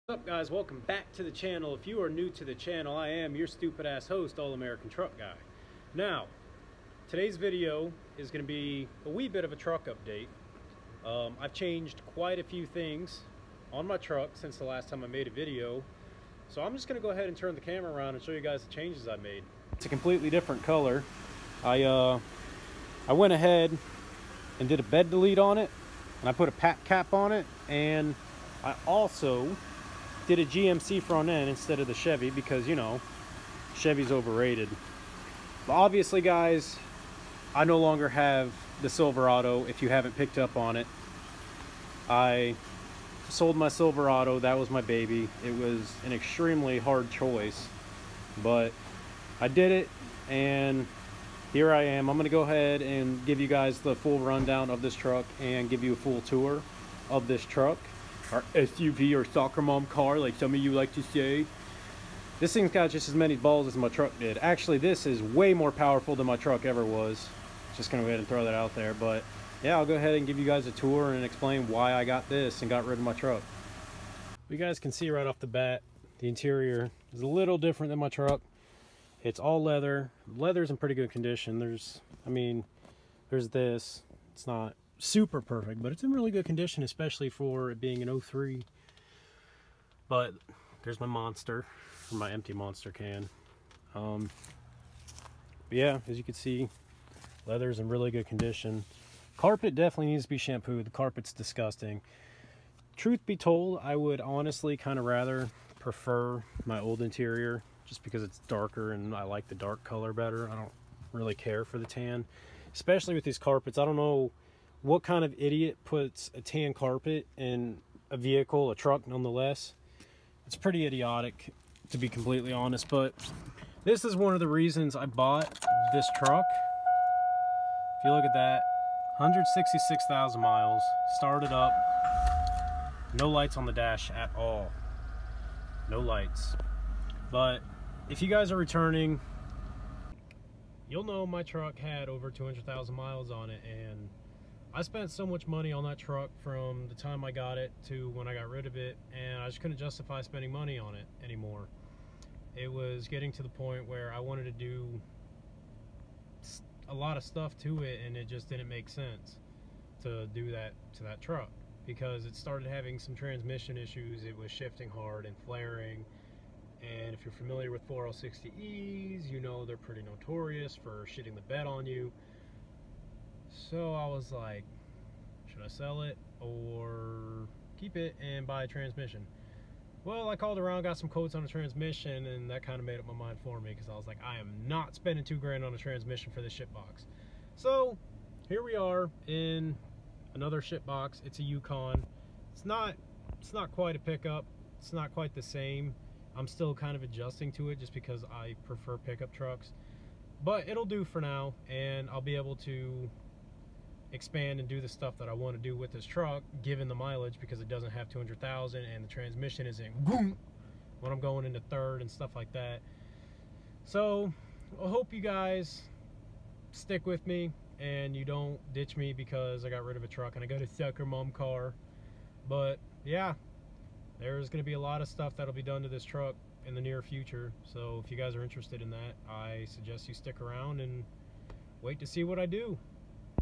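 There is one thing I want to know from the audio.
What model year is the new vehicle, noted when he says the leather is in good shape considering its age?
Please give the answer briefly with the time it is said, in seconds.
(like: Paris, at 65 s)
2003, at 88 s.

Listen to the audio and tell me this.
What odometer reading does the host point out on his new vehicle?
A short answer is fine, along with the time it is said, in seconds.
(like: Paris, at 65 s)
166,000 miles, at 129 s.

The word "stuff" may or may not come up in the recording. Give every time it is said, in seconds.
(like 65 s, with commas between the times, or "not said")
157 s, 204 s, 212 s, 225 s.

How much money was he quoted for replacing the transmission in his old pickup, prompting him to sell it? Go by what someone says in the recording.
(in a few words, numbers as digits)
two grand.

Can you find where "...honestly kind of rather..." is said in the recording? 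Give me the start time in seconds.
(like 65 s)
104 s.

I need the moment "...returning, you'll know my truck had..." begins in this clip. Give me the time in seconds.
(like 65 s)
138 s.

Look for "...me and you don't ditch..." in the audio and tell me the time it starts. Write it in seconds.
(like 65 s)
217 s.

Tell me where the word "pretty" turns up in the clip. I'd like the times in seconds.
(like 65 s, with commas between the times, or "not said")
80 s, 120 s, 169 s.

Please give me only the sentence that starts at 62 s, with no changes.
This thing's got just as many balls as my truck did.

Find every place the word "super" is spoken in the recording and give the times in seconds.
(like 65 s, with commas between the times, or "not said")
85 s.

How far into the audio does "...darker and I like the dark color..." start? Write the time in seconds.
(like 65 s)
108 s.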